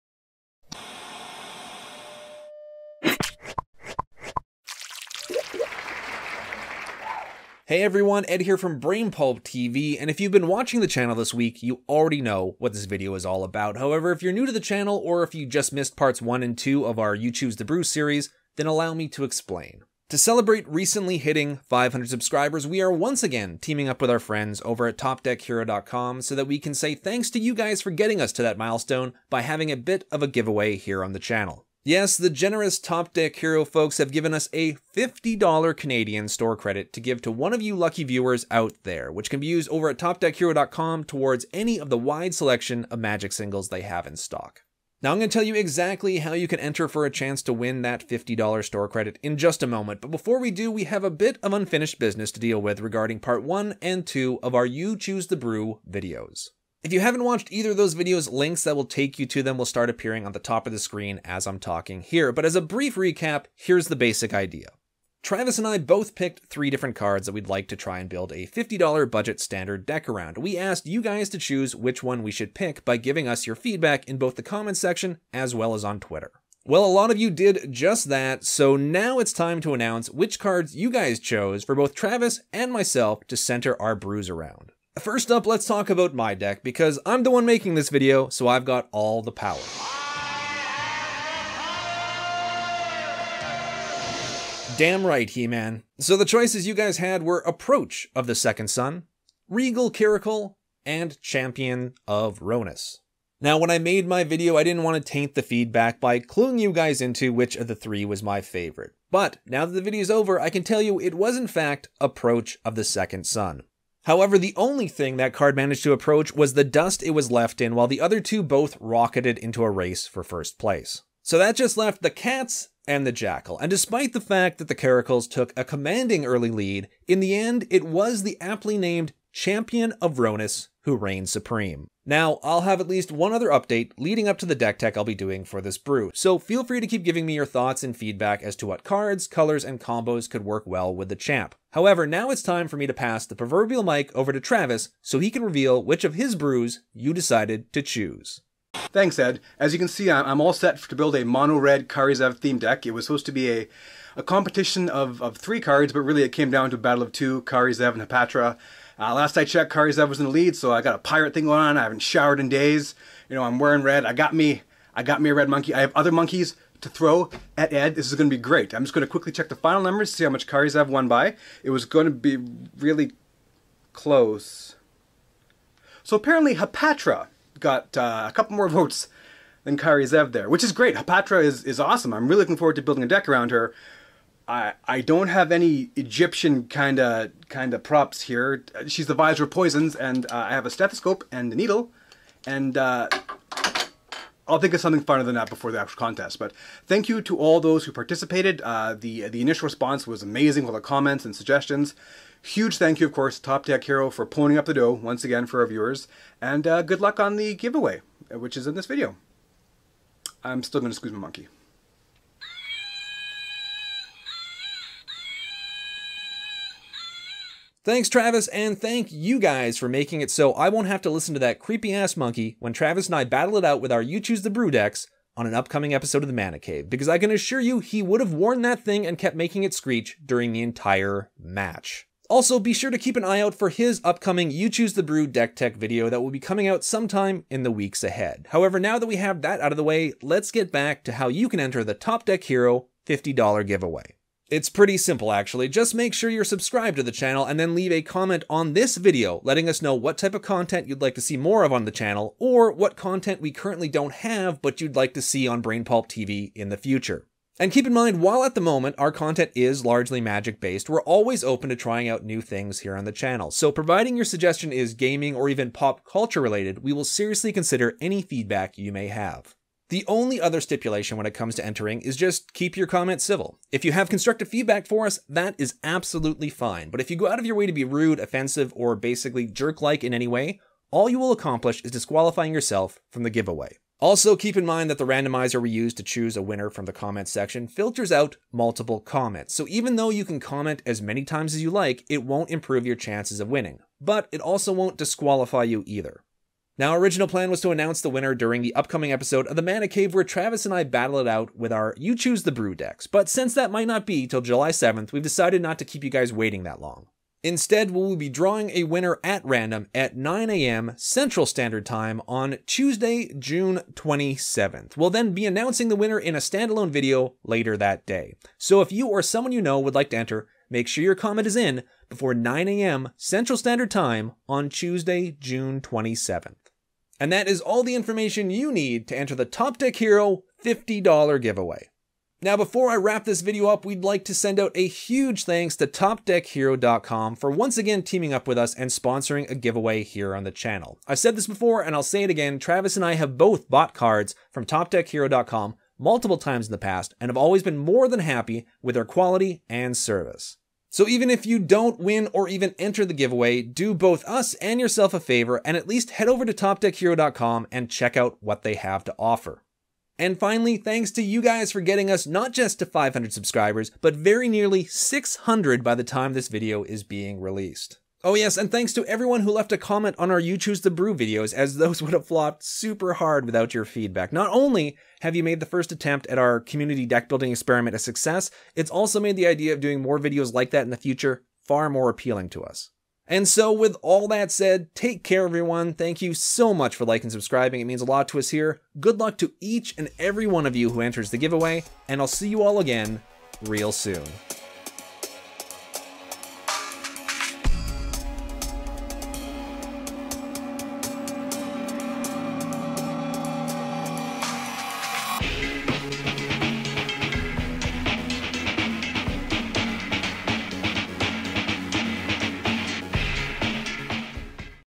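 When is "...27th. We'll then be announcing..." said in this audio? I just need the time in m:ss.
5:13.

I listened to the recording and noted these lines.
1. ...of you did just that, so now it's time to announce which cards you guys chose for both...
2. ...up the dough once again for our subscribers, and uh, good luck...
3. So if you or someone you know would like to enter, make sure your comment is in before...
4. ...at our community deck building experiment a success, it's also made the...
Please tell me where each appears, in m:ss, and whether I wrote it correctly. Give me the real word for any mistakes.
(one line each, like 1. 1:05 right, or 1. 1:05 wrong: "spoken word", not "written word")
1. 1:17 right
2. 3:24 wrong: "viewers", not "subscribers"
3. 5:18 right
4. 6:16 right.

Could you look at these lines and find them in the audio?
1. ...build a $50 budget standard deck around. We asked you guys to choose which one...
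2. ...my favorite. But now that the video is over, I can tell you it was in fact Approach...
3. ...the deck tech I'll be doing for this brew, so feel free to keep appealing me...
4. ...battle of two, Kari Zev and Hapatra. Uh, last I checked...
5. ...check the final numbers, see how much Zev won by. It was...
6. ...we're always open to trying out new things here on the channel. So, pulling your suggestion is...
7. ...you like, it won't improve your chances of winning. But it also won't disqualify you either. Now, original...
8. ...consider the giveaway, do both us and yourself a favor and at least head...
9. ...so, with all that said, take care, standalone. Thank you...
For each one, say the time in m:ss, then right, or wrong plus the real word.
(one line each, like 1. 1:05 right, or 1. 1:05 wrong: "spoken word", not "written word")
1. 1:08 right
2. 1:48 right
3. 2:14 wrong: "giving", not "appealing"
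4. 2:36 right
5. 2:49 right
6. 4:20 wrong: "providing", not "pulling"
7. 4:51 right
8. 5:52 wrong: "enter", not "consider"
9. 6:23 wrong: "everyone", not "standalone".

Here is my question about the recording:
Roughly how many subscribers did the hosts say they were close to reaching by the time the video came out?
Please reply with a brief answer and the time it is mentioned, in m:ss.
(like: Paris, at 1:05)
600, at 6:04.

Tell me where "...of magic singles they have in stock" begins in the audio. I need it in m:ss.
0:42.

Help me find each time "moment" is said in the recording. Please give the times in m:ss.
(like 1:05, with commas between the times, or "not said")
0:49, 4:18.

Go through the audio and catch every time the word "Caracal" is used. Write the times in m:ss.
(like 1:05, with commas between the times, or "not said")
1:39, 2:04.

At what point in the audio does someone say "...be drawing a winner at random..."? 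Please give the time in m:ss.
5:08.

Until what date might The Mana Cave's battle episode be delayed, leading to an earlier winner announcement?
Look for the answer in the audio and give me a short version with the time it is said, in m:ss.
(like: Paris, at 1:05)
July 7th, at 5:04.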